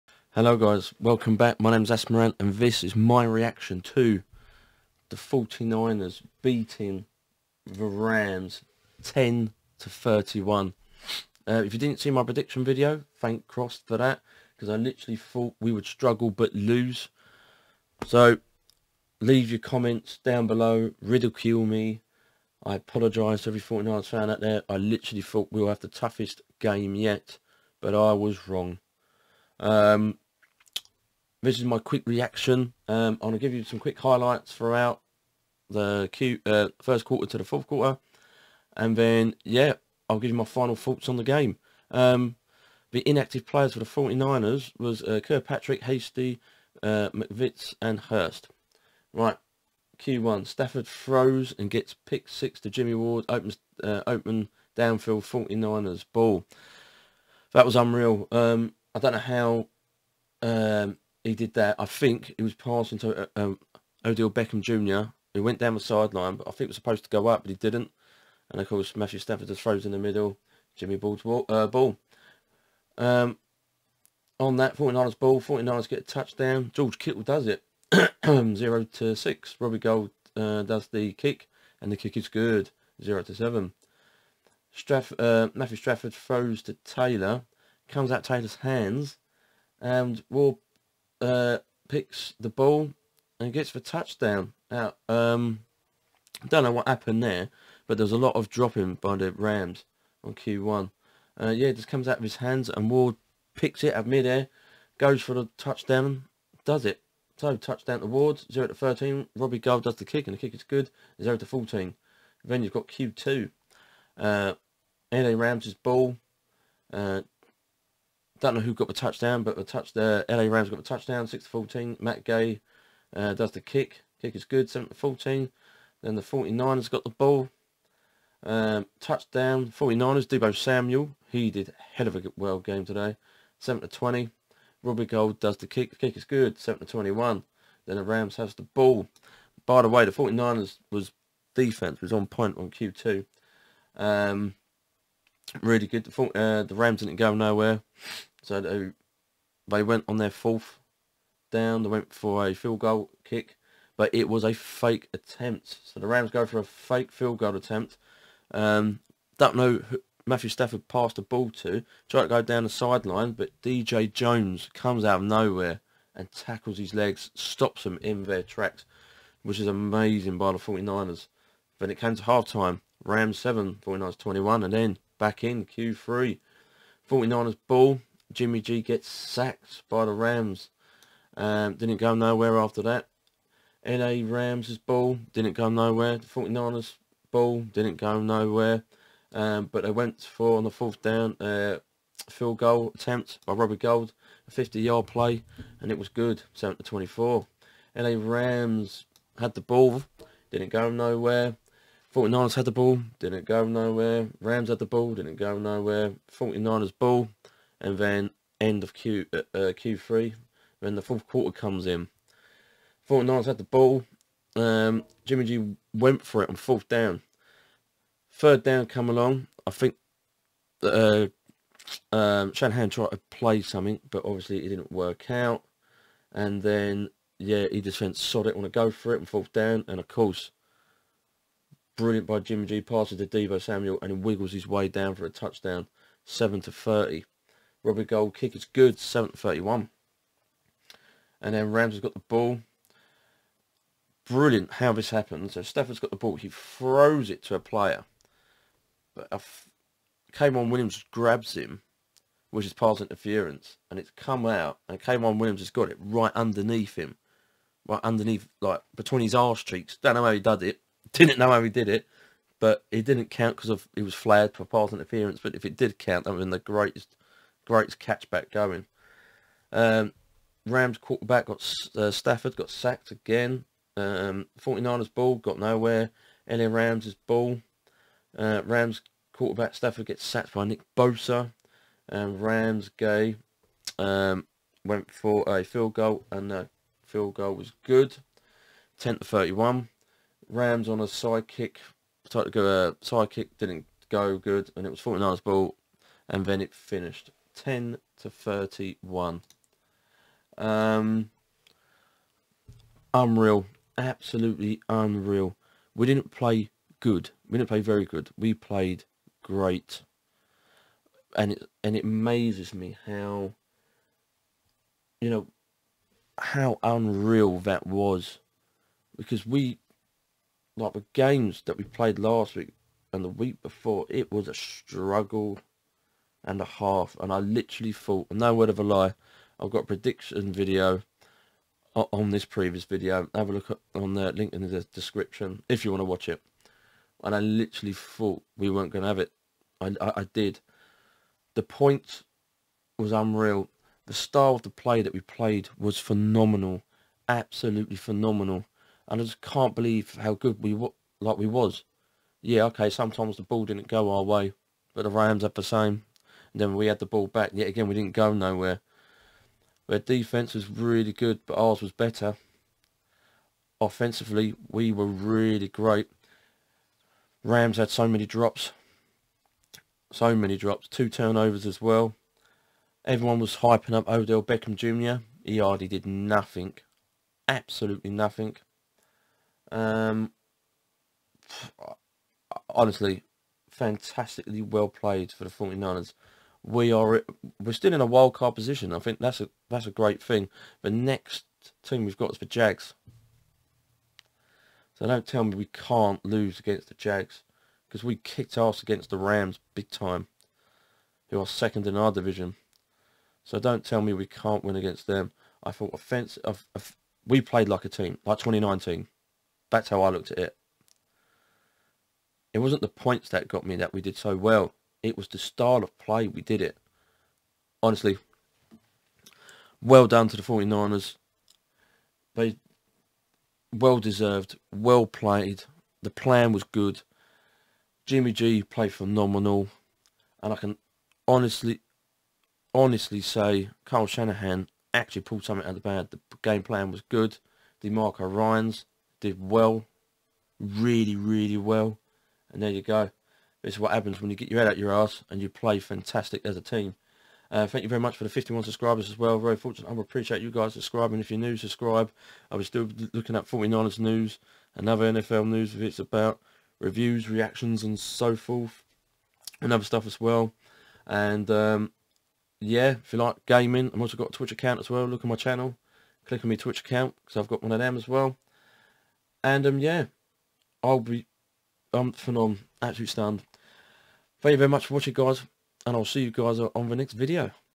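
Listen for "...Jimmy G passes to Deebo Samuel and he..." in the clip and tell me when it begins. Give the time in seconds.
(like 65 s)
232 s.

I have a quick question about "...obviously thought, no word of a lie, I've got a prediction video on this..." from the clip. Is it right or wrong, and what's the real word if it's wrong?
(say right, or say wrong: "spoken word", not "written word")
wrong: "literally", not "obviously".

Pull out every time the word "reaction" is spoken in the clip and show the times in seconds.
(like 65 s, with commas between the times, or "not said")
3 s, 32 s, 457 s.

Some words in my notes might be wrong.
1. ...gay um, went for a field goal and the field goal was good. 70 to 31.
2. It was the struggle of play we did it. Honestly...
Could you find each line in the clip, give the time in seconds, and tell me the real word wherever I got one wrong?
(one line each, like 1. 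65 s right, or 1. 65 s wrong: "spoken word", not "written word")
1. 282 s wrong: "10", not "70"
2. 415 s wrong: "style", not "struggle".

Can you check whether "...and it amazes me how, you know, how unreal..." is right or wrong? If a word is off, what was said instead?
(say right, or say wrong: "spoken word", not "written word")
right.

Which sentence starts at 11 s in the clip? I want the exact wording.
Uh, if you didn't see my prediction video, thank Cross for that because I literally thought we would struggle but lose.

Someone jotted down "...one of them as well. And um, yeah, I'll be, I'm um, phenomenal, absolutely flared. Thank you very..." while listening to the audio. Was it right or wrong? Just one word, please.
wrong.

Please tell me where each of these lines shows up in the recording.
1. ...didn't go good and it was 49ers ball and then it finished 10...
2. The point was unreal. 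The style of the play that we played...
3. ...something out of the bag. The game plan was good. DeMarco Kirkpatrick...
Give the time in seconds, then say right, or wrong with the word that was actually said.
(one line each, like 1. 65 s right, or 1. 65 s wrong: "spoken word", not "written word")
1. 293 s right
2. 341 s right
3. 435 s wrong: "Ryans", not "Kirkpatrick".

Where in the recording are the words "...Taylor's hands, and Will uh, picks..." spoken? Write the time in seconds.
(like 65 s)
88 s.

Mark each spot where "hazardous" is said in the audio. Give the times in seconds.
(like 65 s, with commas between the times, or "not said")
not said.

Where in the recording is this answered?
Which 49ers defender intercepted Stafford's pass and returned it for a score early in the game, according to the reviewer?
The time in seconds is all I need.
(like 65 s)
52 s.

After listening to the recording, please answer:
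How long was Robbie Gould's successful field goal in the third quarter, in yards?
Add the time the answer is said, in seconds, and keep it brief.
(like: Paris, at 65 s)
50, at 194 s.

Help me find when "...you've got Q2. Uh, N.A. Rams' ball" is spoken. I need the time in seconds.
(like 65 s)
112 s.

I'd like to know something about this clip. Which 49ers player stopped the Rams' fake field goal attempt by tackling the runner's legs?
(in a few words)
DJ Jones.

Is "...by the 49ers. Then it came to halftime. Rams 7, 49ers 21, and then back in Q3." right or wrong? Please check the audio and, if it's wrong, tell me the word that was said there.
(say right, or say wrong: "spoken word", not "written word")
right.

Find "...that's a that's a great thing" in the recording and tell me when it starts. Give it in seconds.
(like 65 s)
389 s.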